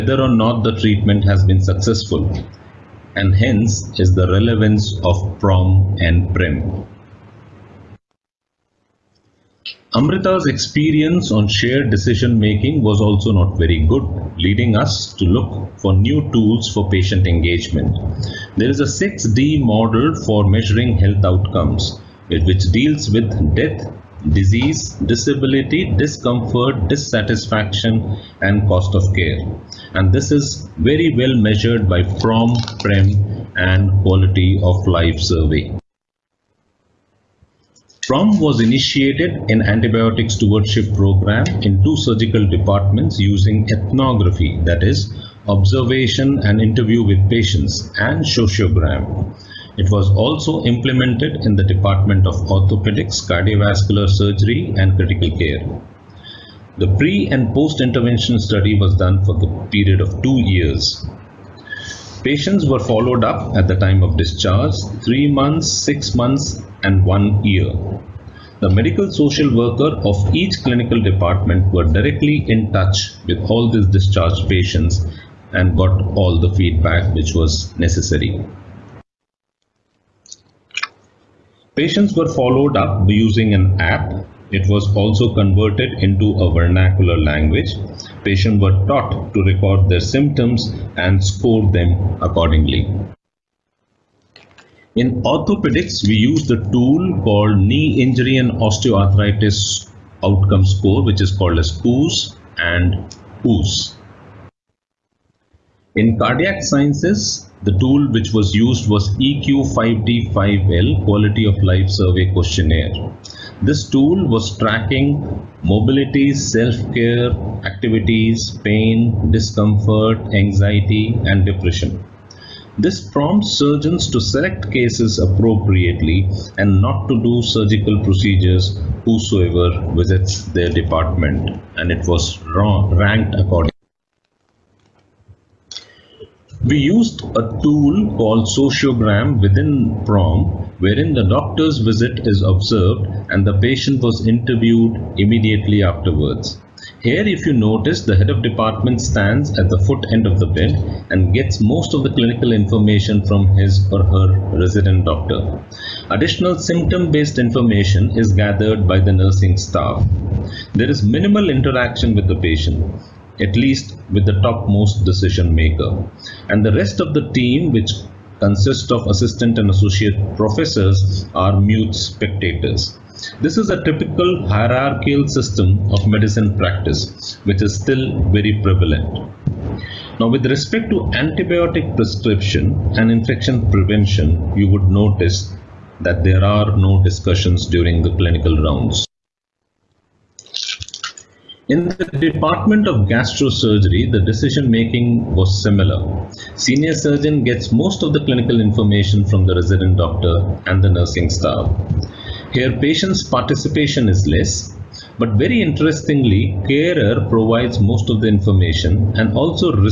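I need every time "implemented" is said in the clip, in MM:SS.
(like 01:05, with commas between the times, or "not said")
00:50.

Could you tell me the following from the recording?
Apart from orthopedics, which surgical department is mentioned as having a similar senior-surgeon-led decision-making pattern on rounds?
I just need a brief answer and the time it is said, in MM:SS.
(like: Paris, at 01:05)
Gastrosurgery, at 03:13.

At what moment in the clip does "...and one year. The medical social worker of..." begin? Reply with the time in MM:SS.
01:06.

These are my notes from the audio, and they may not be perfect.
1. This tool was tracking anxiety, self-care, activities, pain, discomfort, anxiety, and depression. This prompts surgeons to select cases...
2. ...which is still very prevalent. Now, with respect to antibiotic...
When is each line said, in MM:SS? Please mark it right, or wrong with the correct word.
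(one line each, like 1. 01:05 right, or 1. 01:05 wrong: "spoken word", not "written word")
1. 01:53 wrong: "mobility", not "anxiety"
2. 02:57 right.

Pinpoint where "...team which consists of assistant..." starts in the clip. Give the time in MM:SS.
02:47.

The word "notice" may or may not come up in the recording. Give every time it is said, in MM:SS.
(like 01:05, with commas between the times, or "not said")
02:27, 03:04.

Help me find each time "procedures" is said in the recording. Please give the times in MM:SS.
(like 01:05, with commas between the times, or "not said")
02:08.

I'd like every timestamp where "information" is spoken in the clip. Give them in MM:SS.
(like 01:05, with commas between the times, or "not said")
02:32, 02:37, 03:18, 03:28.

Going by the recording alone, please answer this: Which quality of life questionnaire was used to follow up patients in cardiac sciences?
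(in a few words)
EQ5D5L.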